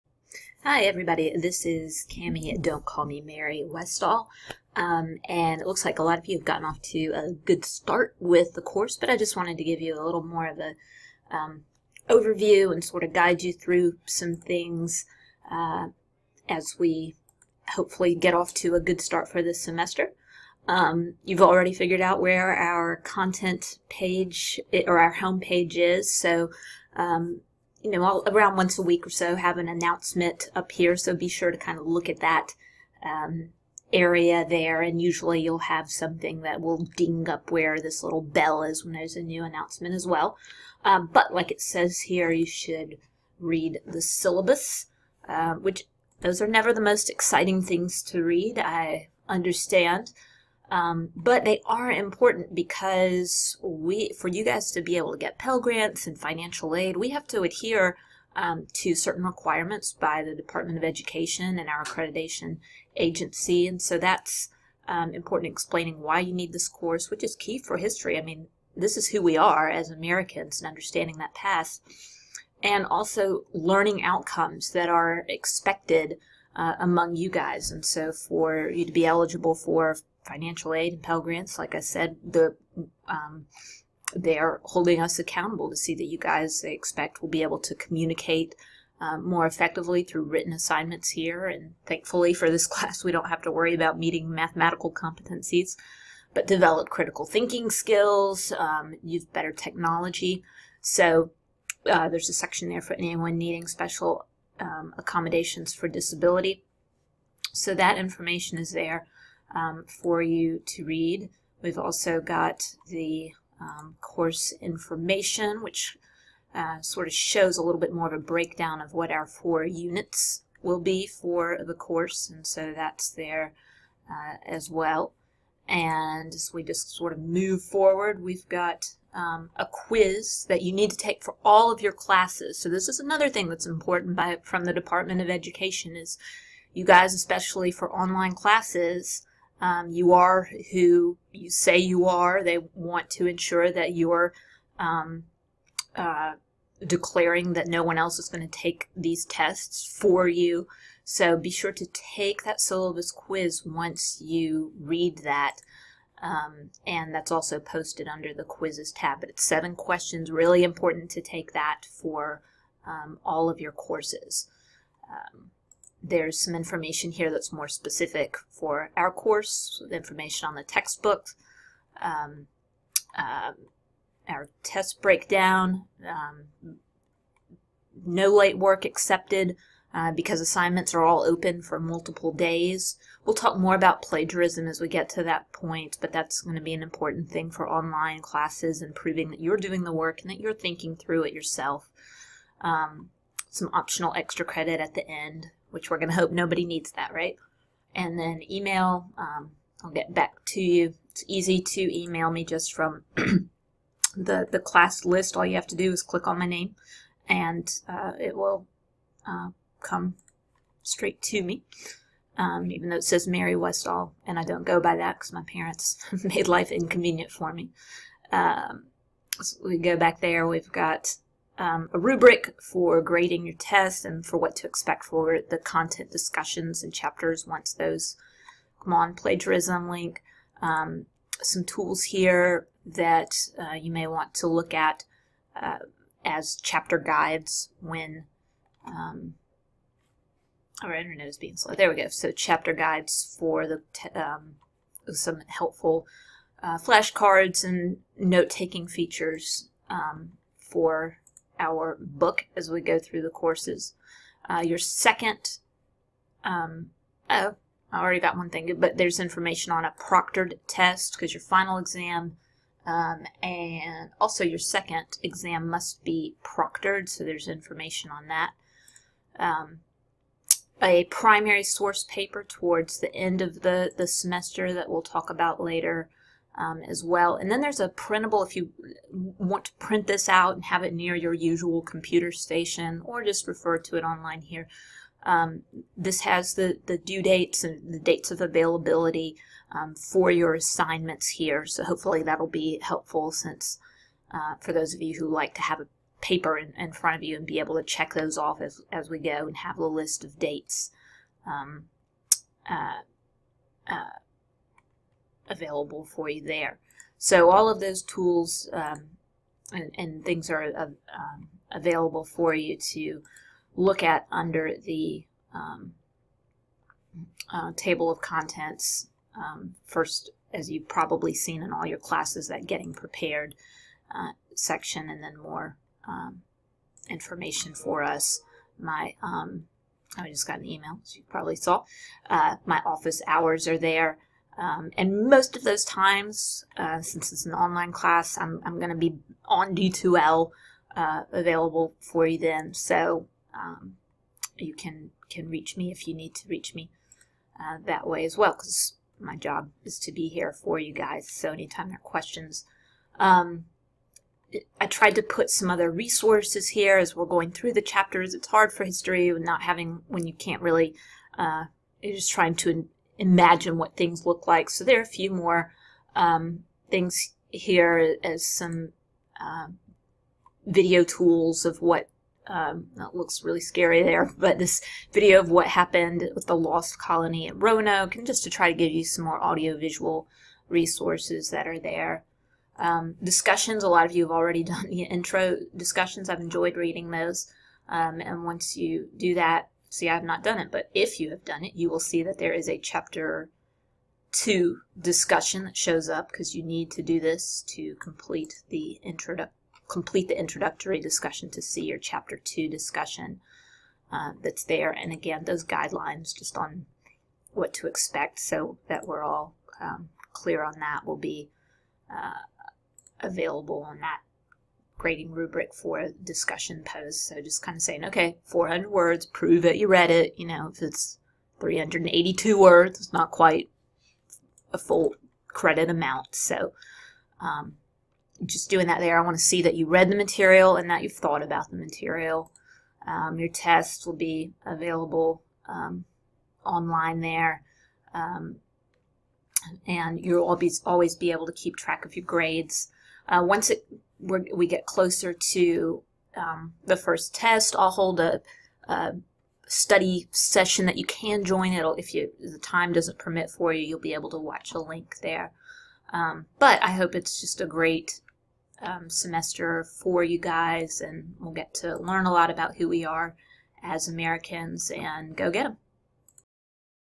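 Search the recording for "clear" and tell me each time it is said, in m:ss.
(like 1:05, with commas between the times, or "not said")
6:50.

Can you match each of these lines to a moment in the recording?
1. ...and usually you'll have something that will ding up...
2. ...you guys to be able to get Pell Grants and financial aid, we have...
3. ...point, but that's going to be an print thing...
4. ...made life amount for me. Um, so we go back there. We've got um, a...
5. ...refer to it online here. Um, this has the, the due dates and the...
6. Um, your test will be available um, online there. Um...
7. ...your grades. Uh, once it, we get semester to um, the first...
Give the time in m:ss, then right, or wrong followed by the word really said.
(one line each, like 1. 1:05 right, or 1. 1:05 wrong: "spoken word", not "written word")
1. 0:34 right
2. 0:54 right
3. 3:05 wrong: "important", not "print"
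4. 3:36 wrong: "inconvenient", not "amount"
5. 4:43 right
6. 7:13 right
7. 7:22 wrong: "closer", not "semester".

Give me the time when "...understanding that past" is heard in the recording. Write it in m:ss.
1:10.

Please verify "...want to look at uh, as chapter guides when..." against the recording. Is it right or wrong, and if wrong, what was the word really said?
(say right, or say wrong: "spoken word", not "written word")
right.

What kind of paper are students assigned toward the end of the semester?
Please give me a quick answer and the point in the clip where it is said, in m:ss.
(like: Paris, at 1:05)
primary source paper, at 4:31.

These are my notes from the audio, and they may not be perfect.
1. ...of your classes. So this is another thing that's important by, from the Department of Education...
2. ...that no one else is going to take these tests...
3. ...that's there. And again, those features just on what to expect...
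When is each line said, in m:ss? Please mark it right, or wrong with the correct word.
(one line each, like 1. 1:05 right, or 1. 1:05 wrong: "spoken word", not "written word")
1. 2:11 right
2. 2:27 right
3. 6:44 wrong: "guidelines", not "features".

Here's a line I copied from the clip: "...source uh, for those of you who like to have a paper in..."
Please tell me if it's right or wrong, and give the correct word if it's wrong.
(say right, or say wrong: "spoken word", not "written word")
wrong: "since", not "source".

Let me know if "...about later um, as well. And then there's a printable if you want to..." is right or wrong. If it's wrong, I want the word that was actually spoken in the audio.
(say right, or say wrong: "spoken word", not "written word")
right.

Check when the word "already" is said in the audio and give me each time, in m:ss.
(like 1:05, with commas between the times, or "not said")
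0:21, 4:18, 6:24.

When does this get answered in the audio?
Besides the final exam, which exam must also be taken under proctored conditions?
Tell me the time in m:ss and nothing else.
4:24.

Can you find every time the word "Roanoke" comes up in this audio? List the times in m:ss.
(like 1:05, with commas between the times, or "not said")
6:17.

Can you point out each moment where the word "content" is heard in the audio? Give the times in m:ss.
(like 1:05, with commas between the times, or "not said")
0:22, 3:45, 5:18.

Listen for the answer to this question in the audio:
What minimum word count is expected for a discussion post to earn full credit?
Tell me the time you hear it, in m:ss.
6:58.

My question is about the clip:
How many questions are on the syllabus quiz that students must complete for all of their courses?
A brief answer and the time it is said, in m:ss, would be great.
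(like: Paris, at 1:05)
7, at 2:39.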